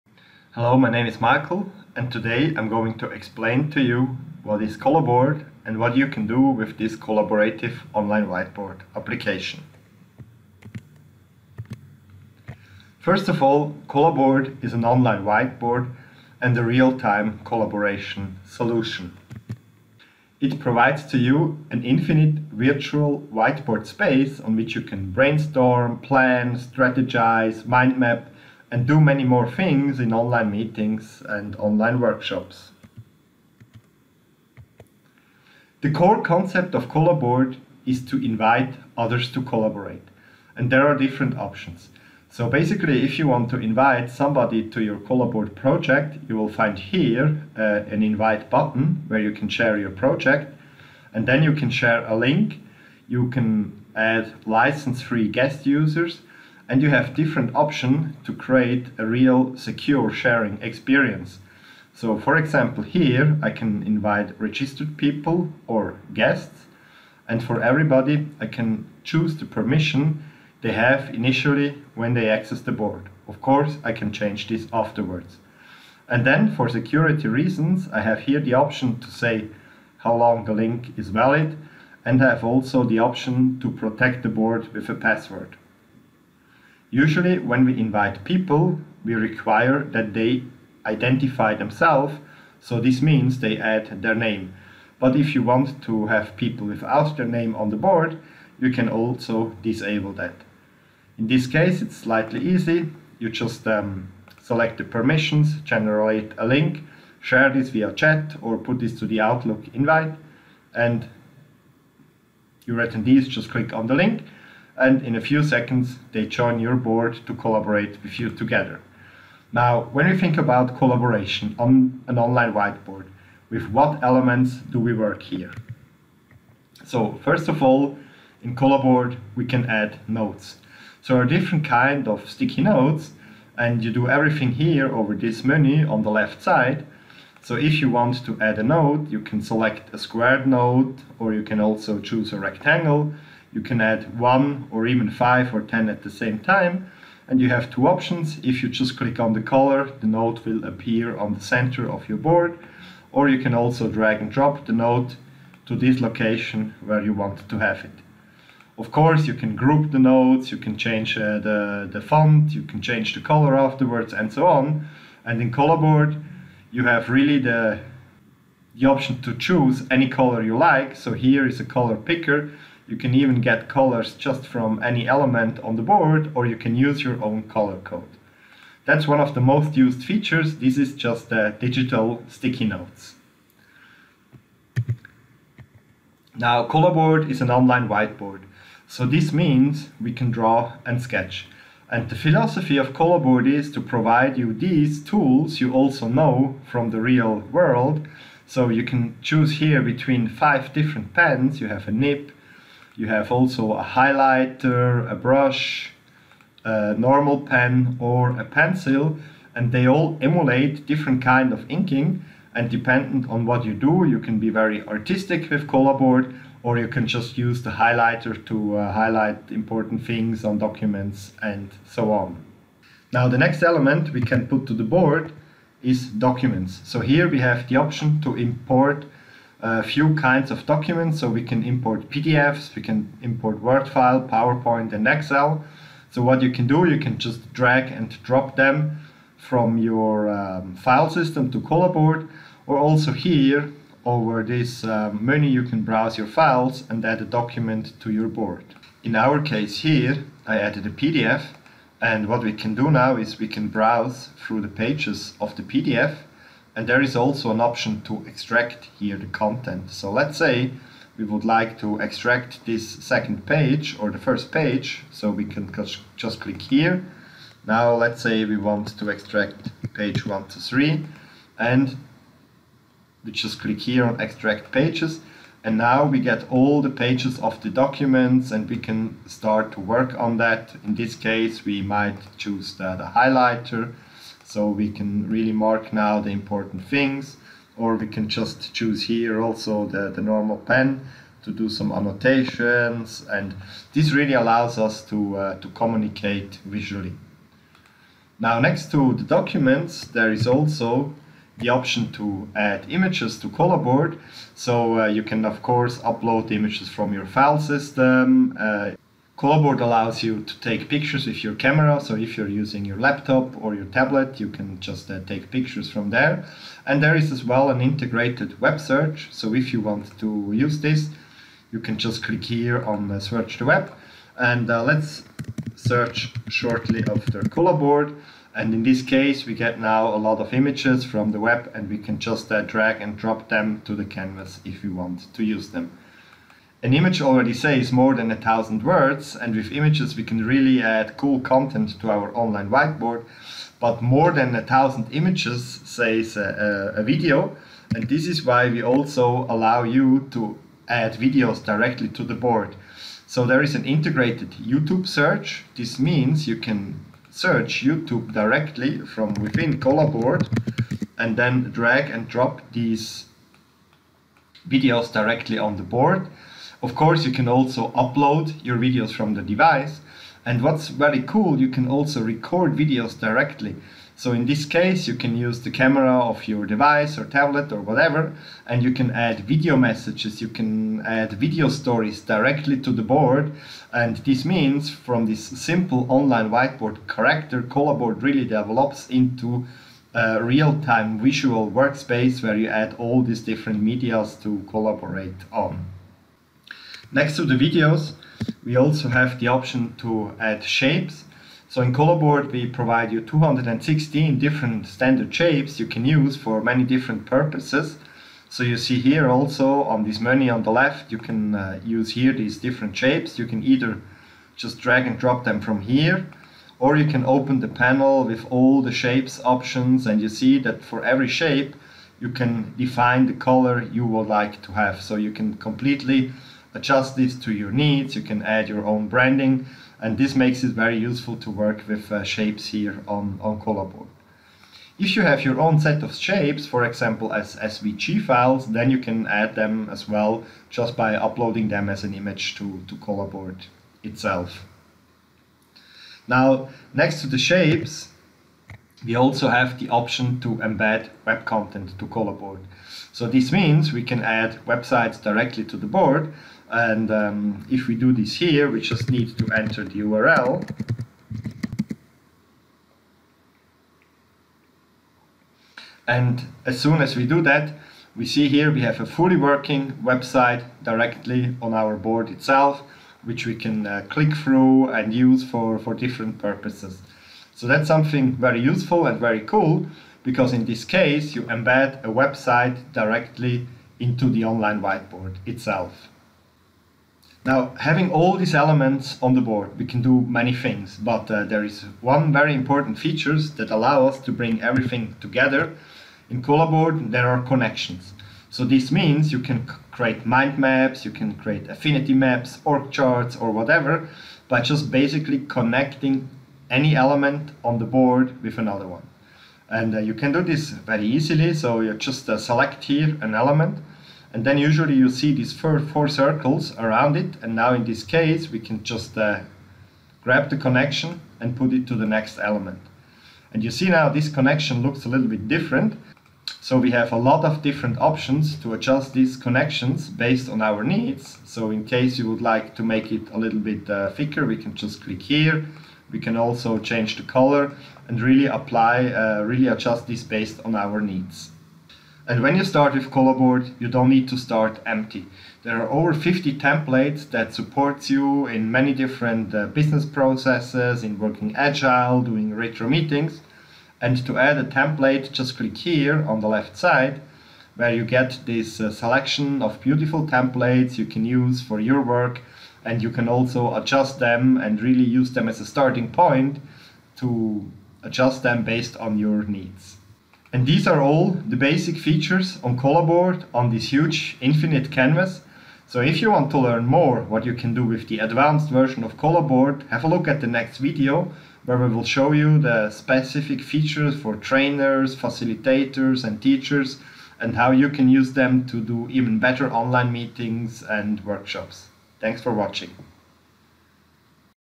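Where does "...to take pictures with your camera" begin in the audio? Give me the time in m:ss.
5:10.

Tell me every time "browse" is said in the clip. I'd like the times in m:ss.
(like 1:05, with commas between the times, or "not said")
4:05, 4:13.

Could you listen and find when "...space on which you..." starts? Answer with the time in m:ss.
0:23.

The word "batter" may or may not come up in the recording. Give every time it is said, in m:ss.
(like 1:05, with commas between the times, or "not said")
not said.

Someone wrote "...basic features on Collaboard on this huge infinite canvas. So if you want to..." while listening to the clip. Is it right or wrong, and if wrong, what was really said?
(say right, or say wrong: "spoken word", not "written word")
right.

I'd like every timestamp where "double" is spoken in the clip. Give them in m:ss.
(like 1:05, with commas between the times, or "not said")
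not said.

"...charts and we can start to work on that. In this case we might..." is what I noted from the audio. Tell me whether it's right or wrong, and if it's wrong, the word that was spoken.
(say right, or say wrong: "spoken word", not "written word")
wrong: "documents", not "charts".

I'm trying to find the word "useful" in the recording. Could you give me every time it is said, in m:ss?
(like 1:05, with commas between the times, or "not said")
7:10, 7:58.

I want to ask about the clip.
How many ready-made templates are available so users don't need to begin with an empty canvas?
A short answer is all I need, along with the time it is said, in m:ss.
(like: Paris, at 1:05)
over 50, at 9:05.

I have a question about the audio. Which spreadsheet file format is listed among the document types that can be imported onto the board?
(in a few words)
Excel.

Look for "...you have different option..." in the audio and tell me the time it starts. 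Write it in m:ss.
0:56.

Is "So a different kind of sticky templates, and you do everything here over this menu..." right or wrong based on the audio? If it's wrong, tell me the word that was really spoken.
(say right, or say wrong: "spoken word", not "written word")
wrong: "notes", not "templates".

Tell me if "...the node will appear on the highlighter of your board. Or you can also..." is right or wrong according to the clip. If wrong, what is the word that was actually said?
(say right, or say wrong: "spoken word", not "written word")
wrong: "center", not "highlighter".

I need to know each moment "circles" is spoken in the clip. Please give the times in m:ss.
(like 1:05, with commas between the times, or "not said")
8:36.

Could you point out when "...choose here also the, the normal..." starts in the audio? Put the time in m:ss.
4:48.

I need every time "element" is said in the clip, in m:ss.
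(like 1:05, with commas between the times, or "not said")
2:04, 2:55, 3:43, 8:08, 8:26, 8:33, 8:42.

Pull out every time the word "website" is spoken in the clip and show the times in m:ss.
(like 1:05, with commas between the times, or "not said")
7:34, 7:50, 8:02.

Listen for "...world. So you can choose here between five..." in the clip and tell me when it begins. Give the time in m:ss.
3:17.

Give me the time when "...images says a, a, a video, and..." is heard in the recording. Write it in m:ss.
5:45.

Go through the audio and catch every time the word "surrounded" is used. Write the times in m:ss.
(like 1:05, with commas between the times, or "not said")
not said.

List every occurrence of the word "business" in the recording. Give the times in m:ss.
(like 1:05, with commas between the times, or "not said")
9:09.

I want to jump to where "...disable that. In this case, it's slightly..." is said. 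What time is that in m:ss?
1:39.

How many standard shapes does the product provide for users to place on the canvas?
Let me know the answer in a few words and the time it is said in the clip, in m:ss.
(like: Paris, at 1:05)
216, at 6:43.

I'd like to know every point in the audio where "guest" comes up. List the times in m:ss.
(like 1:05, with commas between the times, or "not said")
0:55, 1:06.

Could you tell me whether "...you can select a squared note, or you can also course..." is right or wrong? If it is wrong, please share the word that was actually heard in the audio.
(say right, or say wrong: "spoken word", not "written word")
wrong: "choose", not "course".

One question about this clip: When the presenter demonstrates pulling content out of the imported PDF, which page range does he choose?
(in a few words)
1 to 3.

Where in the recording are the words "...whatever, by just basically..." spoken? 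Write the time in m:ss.
8:23.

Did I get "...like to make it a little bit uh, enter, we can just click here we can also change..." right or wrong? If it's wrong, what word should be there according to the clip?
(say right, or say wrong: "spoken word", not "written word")
wrong: "thicker", not "enter".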